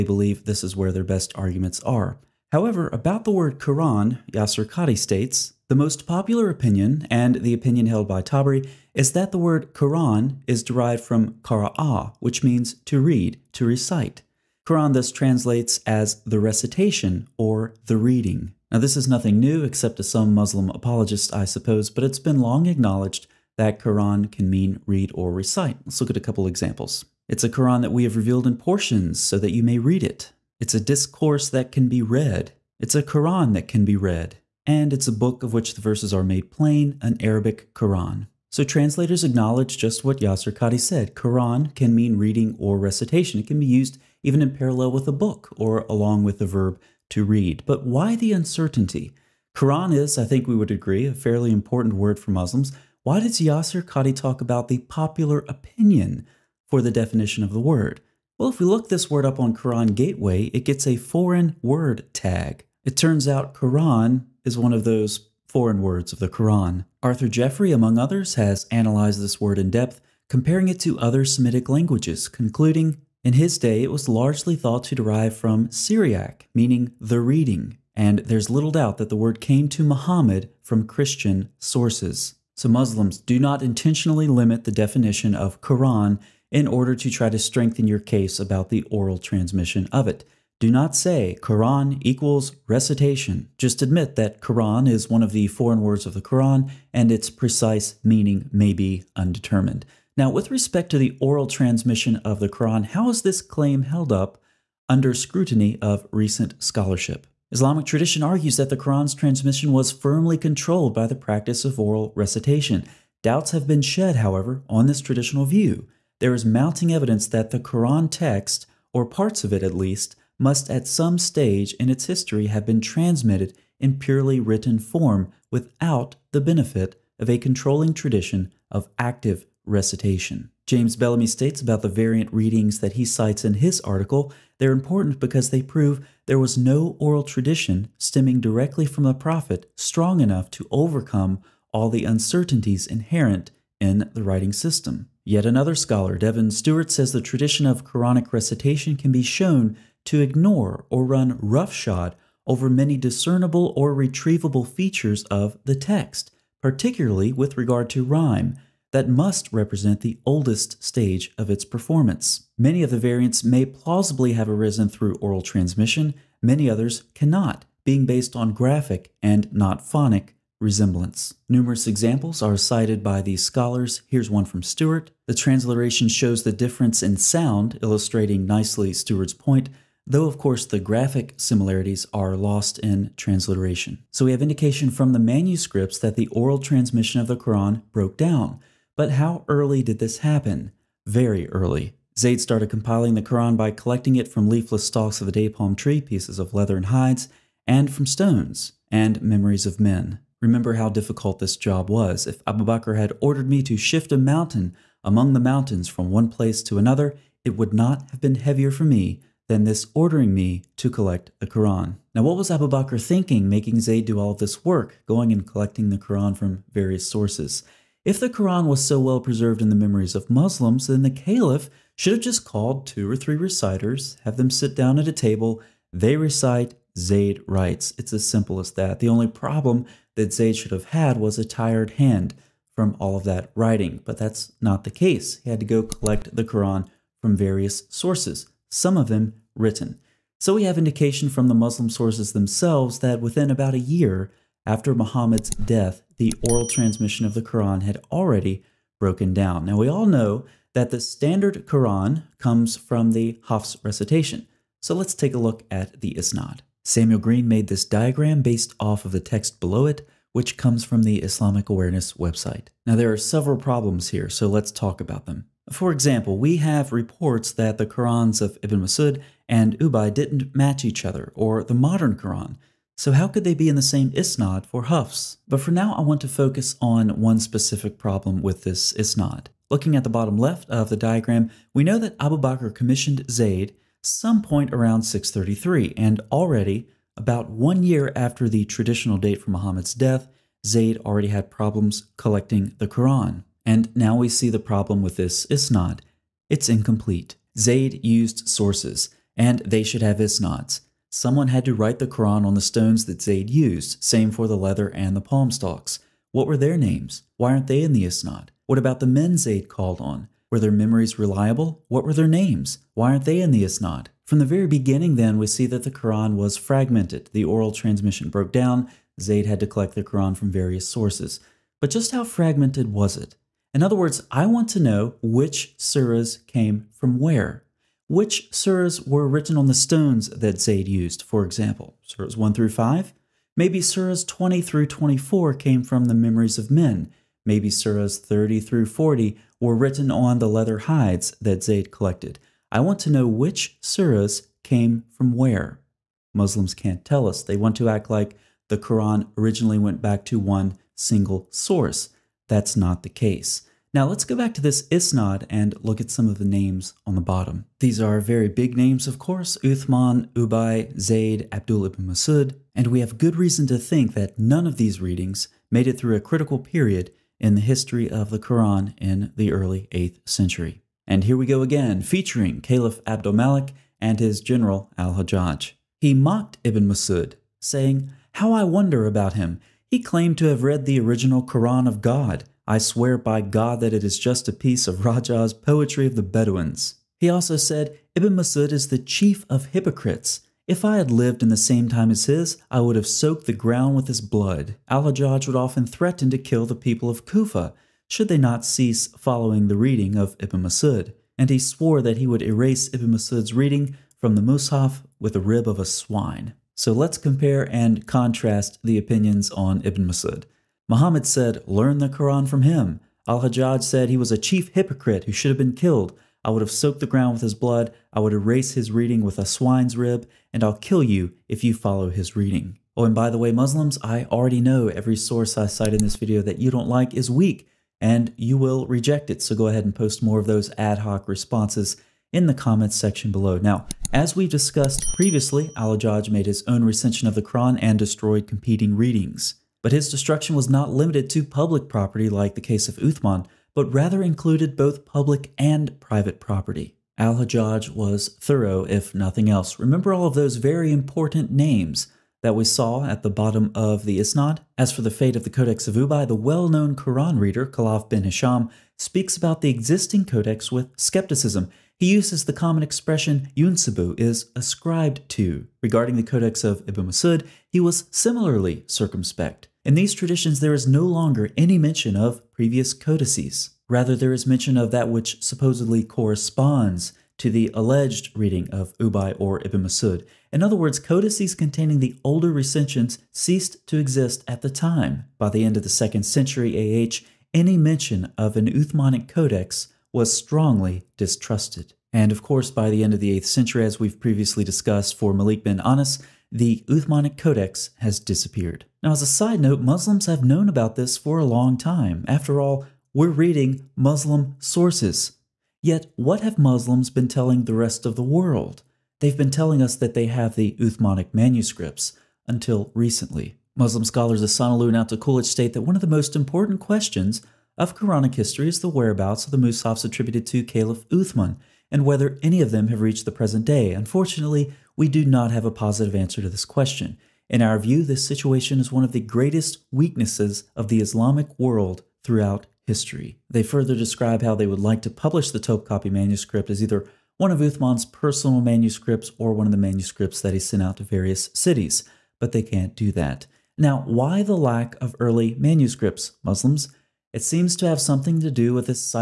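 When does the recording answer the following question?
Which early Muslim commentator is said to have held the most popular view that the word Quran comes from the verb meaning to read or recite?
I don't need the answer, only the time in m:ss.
0:08.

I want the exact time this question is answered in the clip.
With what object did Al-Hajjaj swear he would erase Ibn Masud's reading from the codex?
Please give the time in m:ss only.
6:45.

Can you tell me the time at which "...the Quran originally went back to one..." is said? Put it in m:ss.
5:48.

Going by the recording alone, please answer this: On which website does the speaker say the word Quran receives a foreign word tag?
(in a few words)
Quran Gateway.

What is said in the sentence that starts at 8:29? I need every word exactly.
They've been telling us that they have the Uthmanic manuscripts until recently.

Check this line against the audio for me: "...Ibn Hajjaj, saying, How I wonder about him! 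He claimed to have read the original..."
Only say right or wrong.
wrong.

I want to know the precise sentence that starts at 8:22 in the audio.
After all, we're reading Muslim sources.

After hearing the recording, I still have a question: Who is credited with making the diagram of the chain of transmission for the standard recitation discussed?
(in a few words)
Samuel Green.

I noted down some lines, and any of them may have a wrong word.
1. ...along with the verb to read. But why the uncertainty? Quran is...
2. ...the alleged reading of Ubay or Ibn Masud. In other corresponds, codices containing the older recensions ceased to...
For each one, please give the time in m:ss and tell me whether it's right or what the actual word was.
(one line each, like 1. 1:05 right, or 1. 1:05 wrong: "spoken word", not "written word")
1. 0:45 right
2. 7:57 wrong: "words", not "corresponds".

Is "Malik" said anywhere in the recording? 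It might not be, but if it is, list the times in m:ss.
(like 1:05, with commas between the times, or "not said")
6:13, 8:15.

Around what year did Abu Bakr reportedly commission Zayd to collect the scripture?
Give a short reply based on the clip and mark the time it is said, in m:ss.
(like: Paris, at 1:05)
633, at 4:45.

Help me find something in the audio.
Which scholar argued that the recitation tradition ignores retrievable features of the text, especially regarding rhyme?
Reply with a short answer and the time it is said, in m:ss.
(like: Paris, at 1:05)
Devin Stewart, at 2:26.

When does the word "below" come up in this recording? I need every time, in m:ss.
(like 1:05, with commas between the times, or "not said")
4:19, 7:13.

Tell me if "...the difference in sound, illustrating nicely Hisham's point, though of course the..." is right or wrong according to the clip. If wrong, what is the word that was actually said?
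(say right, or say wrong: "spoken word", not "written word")
wrong: "Stewart", not "Hisham".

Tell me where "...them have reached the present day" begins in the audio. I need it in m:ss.
8:42.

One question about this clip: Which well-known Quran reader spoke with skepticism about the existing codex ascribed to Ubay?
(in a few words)
Khalaf bin Hisham.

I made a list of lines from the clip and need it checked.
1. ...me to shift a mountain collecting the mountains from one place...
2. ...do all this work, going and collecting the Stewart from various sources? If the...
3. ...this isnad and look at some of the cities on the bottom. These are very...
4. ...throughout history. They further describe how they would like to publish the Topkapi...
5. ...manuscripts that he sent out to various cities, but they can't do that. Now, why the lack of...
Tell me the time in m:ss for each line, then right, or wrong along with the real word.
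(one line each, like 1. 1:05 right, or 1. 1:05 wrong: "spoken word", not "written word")
1. 3:23 wrong: "among", not "collecting"
2. 3:34 wrong: "Quran", not "Stewart"
3. 5:54 wrong: "names", not "cities"
4. 8:52 right
5. 8:59 right.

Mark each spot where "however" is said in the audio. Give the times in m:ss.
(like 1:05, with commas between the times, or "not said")
0:02, 1:54.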